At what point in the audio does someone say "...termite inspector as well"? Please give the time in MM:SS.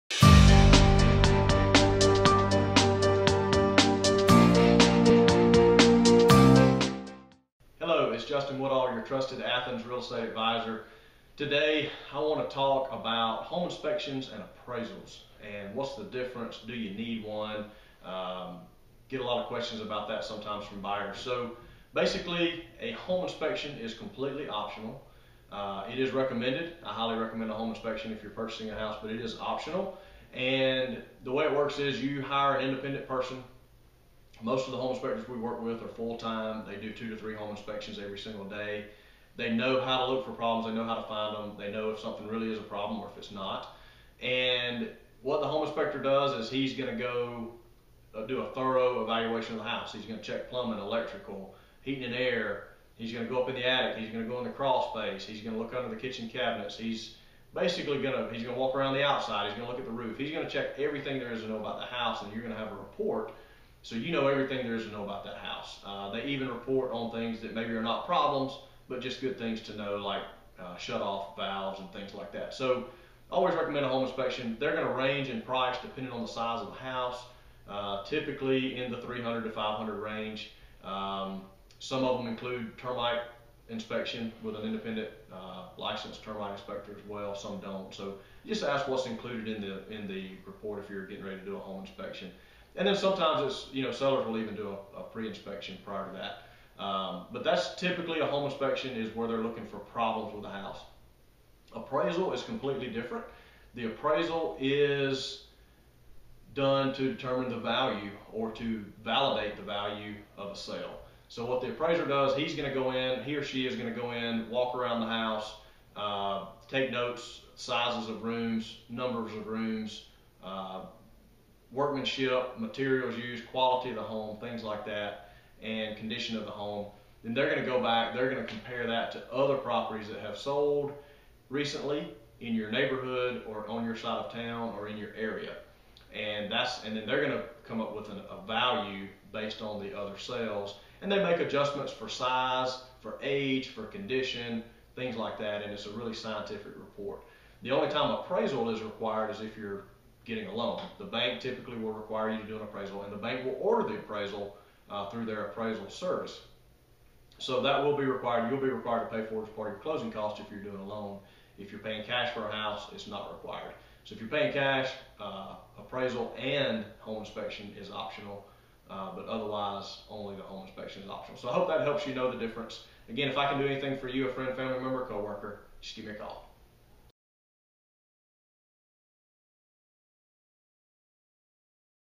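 01:26.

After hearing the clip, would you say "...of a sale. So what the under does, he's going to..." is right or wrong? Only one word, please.
wrong.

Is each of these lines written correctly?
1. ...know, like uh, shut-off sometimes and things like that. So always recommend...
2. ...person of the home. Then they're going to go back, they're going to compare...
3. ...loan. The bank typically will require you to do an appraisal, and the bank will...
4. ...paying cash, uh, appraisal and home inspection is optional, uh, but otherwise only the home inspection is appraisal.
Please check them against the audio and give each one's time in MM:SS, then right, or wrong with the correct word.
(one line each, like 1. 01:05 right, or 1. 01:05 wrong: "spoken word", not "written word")
1. 01:09 wrong: "valves", not "sometimes"
2. 02:05 wrong: "condition", not "person"
3. 02:30 right
4. 02:44 wrong: "optional", not "appraisal".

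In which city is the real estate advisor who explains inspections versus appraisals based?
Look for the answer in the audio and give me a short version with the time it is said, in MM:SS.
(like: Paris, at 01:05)
Athens, at 00:09.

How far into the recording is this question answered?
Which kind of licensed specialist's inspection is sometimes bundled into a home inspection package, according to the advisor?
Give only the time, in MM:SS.
01:22.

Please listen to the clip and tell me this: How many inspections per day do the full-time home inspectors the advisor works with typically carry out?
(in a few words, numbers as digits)
2 to 3.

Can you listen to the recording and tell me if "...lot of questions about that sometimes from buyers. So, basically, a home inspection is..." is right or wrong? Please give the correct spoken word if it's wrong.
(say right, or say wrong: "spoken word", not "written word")
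right.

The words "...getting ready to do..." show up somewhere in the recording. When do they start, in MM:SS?
01:31.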